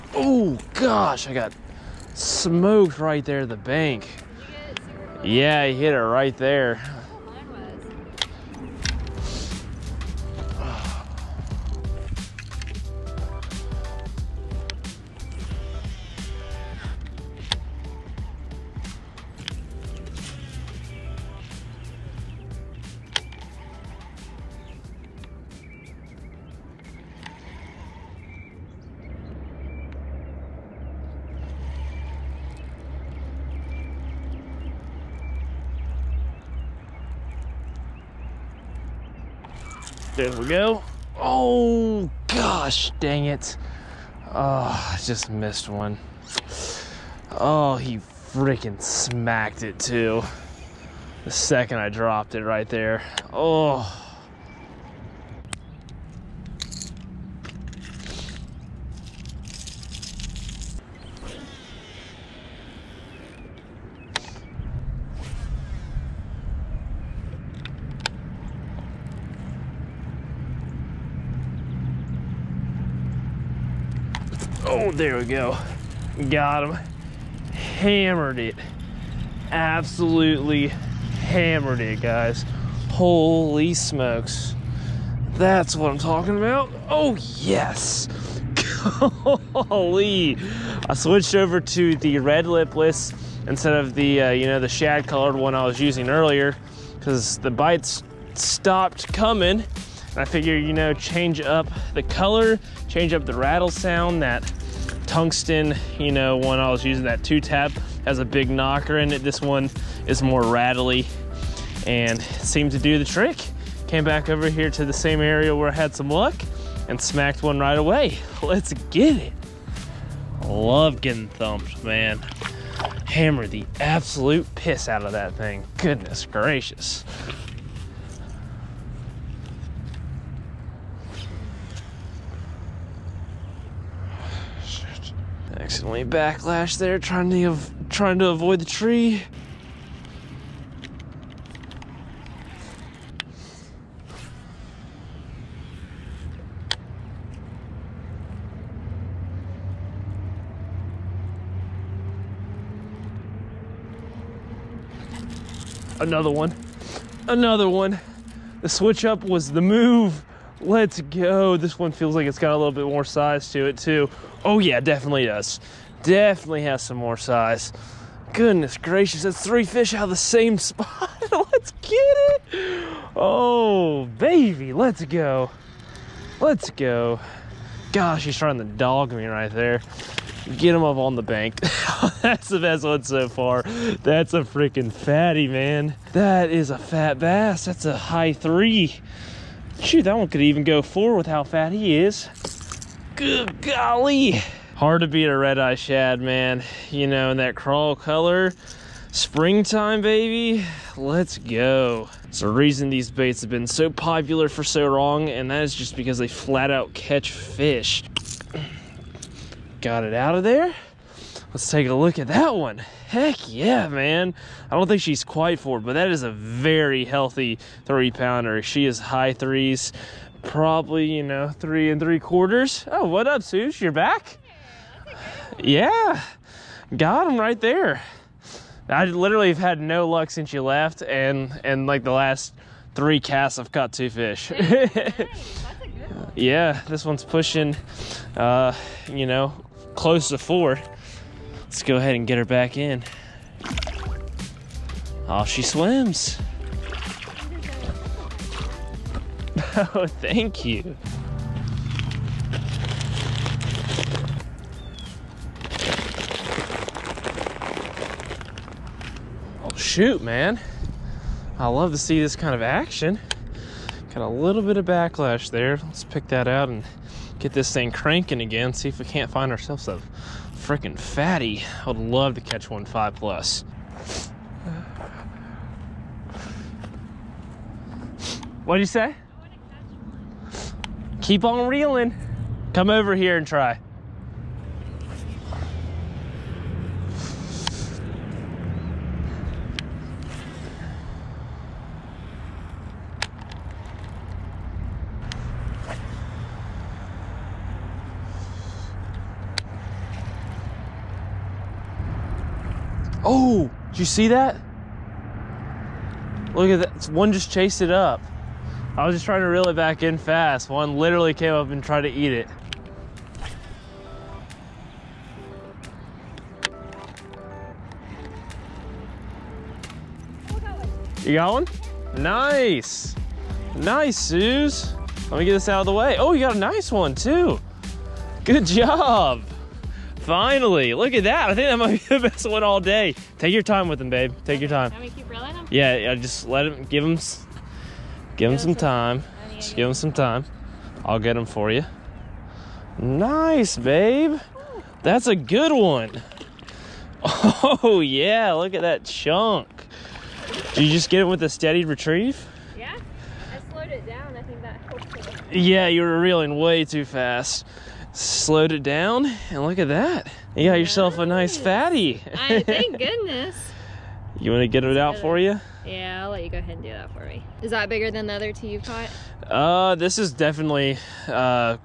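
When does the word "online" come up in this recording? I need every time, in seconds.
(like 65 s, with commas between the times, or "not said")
not said.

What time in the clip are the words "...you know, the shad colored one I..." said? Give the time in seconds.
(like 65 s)
94 s.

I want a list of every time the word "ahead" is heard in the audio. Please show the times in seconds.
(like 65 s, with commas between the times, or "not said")
241 s, 366 s.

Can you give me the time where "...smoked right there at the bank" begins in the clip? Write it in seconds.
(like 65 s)
2 s.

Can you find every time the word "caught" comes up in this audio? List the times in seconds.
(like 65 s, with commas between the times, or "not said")
233 s, 368 s.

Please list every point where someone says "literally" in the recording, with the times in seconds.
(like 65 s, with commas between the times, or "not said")
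229 s, 310 s.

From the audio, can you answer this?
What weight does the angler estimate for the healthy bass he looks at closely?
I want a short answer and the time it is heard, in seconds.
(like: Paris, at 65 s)
3.75 pounds, at 221 s.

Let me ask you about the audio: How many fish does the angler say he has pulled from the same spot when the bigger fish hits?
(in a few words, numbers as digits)
3.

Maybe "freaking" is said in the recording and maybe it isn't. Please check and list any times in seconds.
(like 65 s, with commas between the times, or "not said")
47 s, 184 s, 270 s.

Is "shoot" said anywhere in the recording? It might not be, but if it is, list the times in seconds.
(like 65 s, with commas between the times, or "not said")
189 s, 259 s.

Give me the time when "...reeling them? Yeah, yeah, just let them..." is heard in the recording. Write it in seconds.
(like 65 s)
335 s.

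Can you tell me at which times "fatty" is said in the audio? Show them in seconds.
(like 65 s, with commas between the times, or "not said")
184 s, 270 s, 361 s.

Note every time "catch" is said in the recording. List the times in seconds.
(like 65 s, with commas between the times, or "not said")
206 s, 272 s.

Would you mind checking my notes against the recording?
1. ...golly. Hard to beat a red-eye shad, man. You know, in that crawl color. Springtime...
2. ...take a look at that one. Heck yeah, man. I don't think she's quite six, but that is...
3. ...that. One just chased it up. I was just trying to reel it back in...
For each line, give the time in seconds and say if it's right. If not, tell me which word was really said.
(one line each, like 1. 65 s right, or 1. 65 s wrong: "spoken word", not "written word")
1. 193 s right
2. 211 s wrong: "four", not "six"
3. 306 s right.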